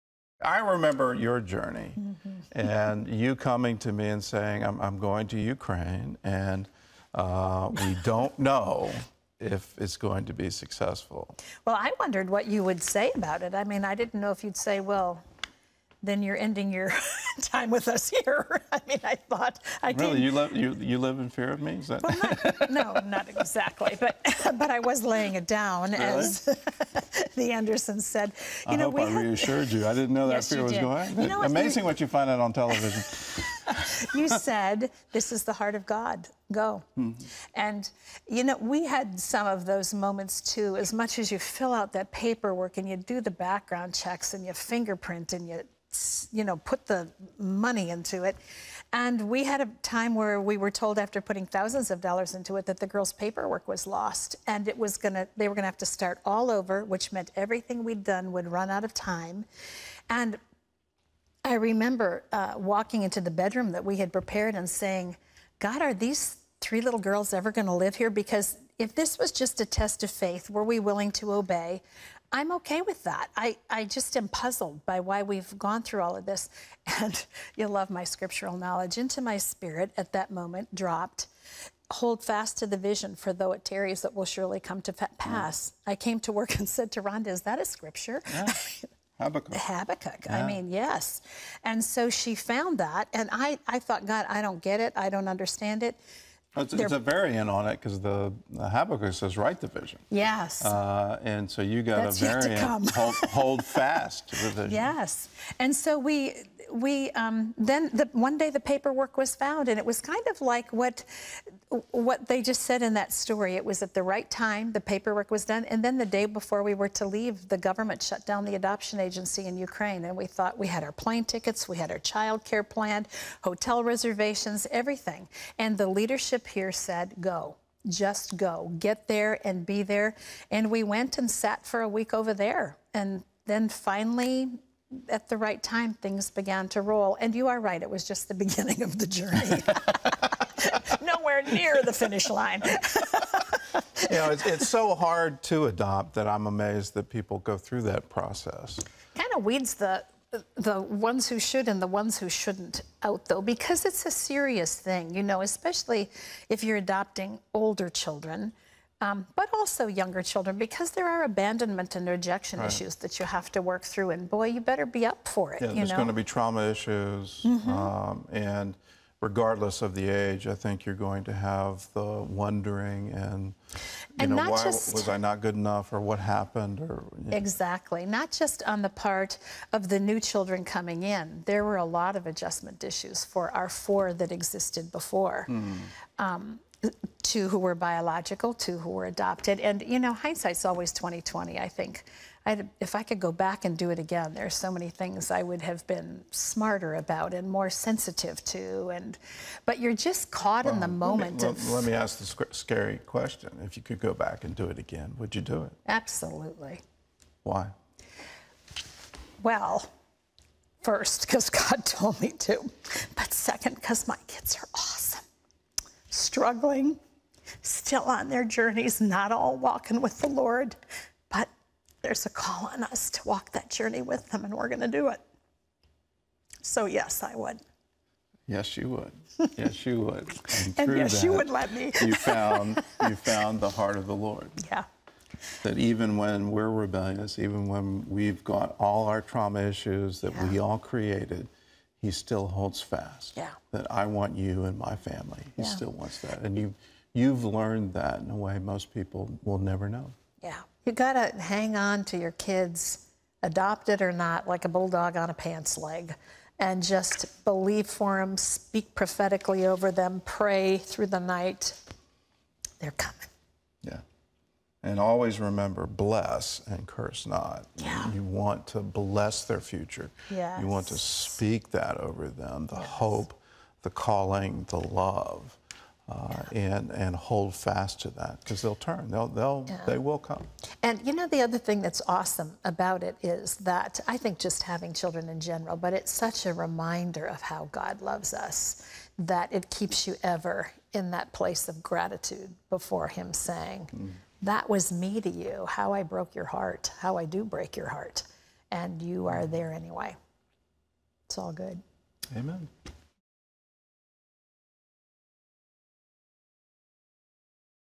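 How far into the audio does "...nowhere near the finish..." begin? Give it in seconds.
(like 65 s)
141 s.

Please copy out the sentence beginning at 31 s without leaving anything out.
You know, Amazing what you find out on television.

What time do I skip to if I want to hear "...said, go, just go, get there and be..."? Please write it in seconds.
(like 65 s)
126 s.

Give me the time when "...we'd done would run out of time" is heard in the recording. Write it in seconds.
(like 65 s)
57 s.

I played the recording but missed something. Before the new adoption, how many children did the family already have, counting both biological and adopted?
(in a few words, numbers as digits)
4.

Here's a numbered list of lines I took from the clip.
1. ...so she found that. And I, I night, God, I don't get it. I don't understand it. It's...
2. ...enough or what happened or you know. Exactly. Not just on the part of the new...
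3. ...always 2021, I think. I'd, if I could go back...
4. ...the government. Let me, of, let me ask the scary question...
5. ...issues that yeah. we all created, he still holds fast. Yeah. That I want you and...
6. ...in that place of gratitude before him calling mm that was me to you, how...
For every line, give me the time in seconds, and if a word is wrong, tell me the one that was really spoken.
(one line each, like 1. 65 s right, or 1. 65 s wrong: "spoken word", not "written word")
1. 91 s wrong: "thought", not "night"
2. 175 s right
3. 190 s wrong: "2020", not "2021"
4. 200 s wrong: "moment", not "government"
5. 239 s right
6. 290 s wrong: "saying", not "calling".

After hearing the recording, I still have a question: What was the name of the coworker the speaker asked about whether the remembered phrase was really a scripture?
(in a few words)
Rhonda.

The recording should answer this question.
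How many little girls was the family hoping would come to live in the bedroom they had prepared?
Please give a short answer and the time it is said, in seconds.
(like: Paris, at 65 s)
3, at 66 s.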